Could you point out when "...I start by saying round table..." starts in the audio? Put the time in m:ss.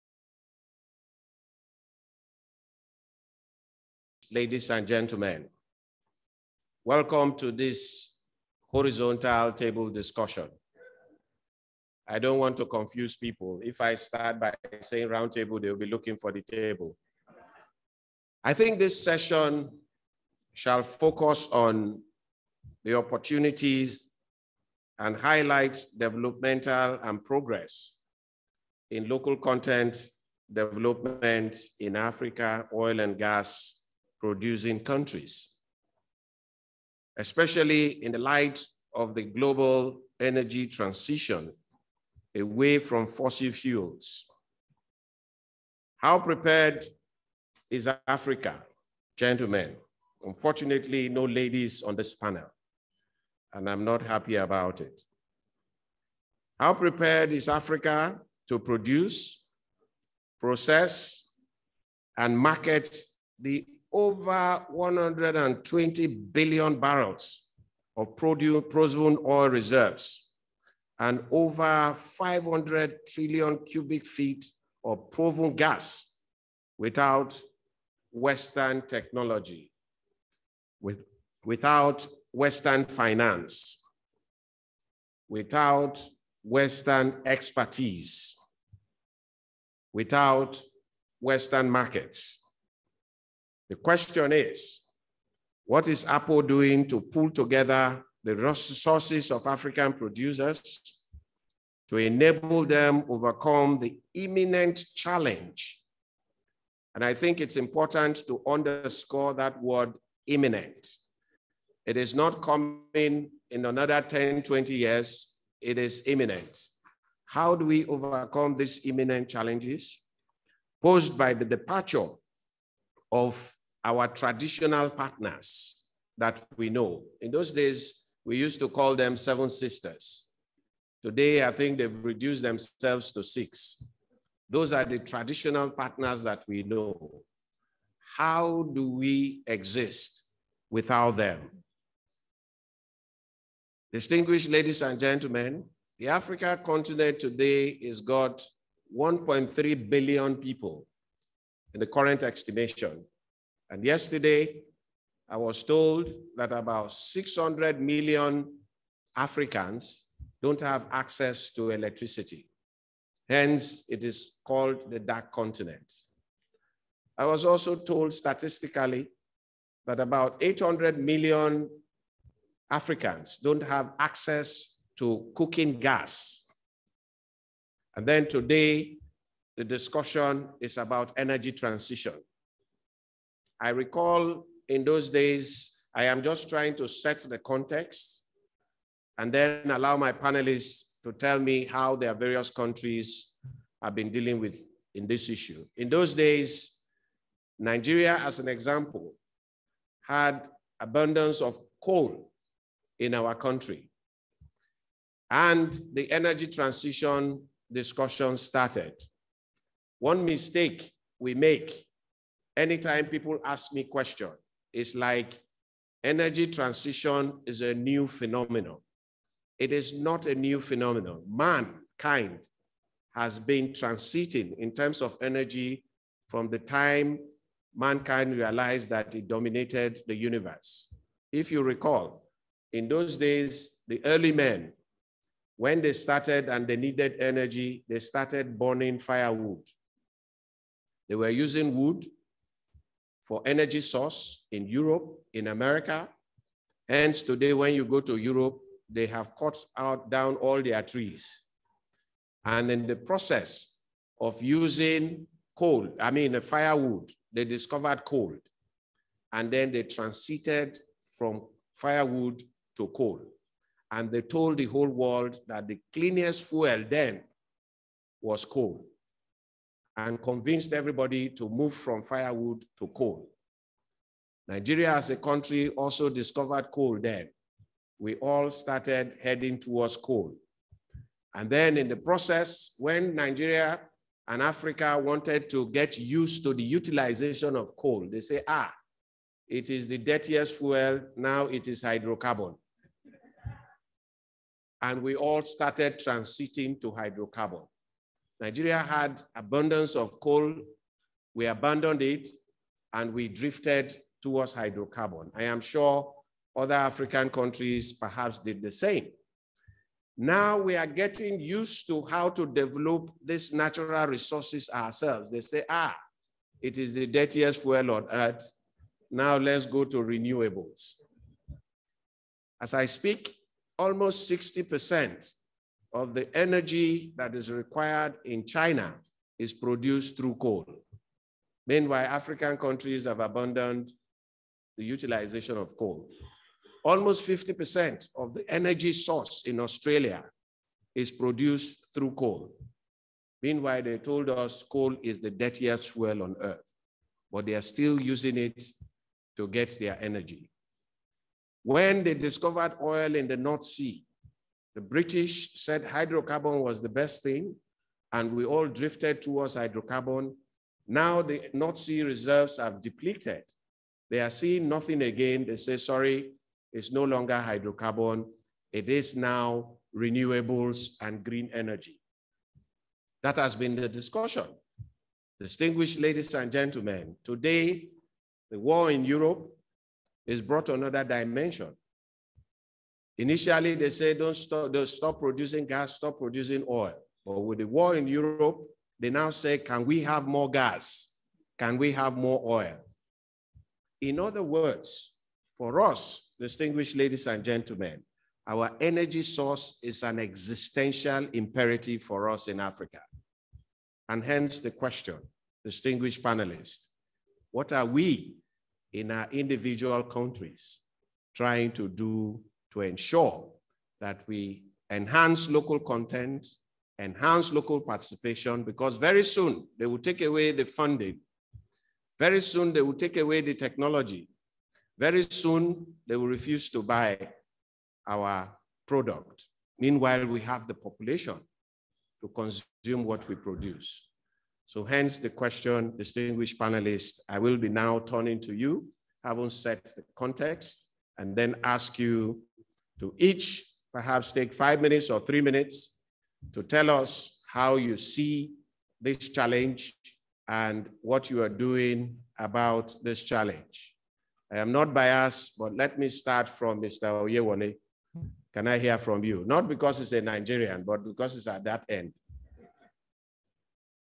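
0:13.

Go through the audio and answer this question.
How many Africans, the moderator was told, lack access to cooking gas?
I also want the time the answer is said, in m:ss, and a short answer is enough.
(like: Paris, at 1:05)
800 million, at 2:50.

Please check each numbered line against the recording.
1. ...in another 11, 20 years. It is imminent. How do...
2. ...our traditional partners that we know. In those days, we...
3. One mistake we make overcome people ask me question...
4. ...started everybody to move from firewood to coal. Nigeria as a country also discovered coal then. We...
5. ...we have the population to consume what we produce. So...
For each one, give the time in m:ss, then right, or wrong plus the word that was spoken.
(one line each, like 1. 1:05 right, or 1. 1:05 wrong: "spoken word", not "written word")
1. 1:53 wrong: "10", not "11"
2. 2:03 right
3. 3:29 wrong: "anytime", not "overcome"
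4. 4:30 wrong: "convinced", not "started"
5. 7:10 right.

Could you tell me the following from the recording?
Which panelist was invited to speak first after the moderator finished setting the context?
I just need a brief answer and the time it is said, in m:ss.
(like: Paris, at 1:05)
Mr. Oyewole, at 7:36.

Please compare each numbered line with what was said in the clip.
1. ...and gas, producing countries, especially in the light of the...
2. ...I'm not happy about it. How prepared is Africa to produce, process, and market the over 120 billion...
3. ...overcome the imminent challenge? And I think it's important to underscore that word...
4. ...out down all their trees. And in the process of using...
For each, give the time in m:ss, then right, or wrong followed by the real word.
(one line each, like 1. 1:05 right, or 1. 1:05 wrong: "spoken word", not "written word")
1. 0:33 right
2. 0:53 right
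3. 1:43 right
4. 4:09 right.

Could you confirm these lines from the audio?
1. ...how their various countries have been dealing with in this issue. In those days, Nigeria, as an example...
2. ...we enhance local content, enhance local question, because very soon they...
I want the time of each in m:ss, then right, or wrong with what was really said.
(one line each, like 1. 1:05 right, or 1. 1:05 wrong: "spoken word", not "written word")
1. 3:11 right
2. 6:54 wrong: "participation", not "question".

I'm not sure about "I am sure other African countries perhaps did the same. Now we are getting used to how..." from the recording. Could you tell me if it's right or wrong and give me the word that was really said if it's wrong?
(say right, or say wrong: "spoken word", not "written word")
right.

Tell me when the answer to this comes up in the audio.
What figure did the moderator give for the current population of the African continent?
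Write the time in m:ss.
2:28.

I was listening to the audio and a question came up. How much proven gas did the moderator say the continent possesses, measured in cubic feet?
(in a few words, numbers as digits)
500 trillion cubic feet.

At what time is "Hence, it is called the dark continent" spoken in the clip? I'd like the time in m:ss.
2:43.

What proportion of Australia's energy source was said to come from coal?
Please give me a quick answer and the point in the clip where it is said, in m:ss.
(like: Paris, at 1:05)
50%, at 5:37.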